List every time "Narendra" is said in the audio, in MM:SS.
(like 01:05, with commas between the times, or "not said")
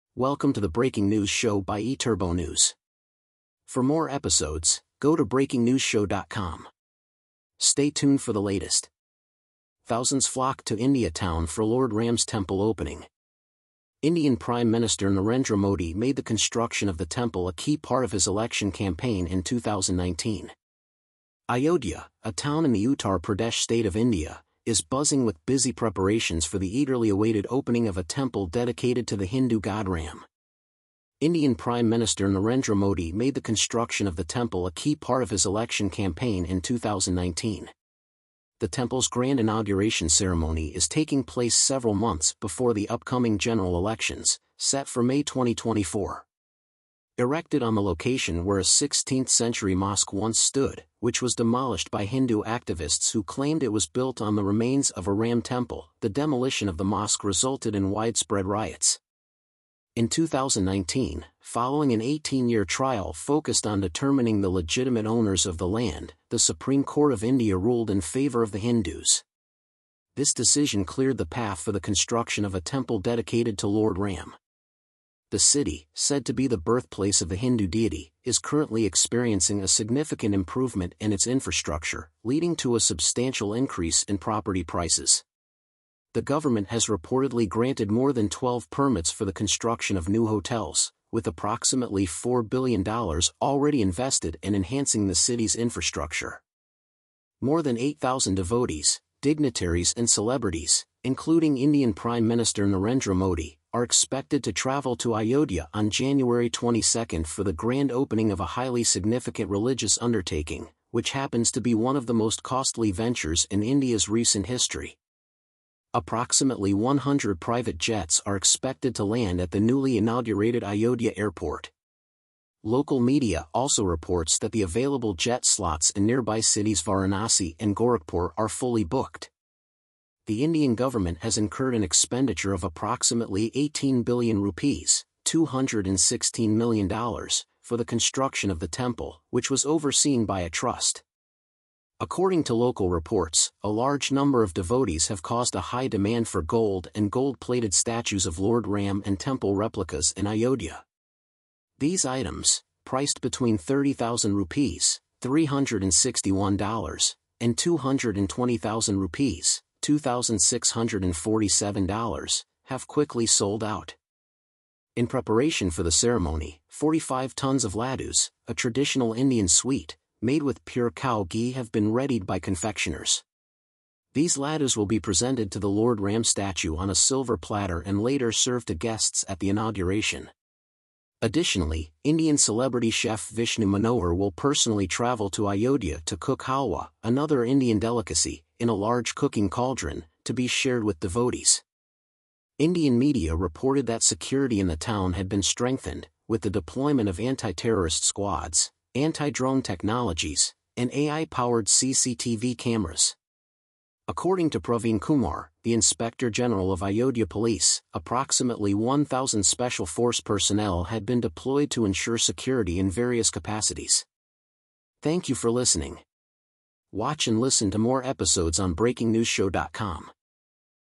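00:15, 00:32, 01:42.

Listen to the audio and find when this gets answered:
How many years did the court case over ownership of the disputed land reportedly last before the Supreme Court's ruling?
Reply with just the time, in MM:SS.
01:02.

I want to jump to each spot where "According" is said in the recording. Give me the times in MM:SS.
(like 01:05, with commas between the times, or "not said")
02:21, 03:24.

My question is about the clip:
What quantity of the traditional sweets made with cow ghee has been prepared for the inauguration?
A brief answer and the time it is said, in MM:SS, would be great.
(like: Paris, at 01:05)
45 tons, at 02:46.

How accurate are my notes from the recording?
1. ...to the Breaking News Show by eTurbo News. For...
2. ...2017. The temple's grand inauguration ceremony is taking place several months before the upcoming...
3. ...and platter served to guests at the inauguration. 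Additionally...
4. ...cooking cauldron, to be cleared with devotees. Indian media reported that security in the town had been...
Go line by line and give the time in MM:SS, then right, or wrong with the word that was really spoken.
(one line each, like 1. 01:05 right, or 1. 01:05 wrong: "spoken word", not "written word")
1. 00:00 right
2. 00:36 wrong: "2019", not "2017"
3. 02:57 wrong: "later", not "platter"
4. 03:09 wrong: "shared", not "cleared".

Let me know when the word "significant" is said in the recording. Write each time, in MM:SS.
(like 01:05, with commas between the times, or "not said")
01:19, 01:48.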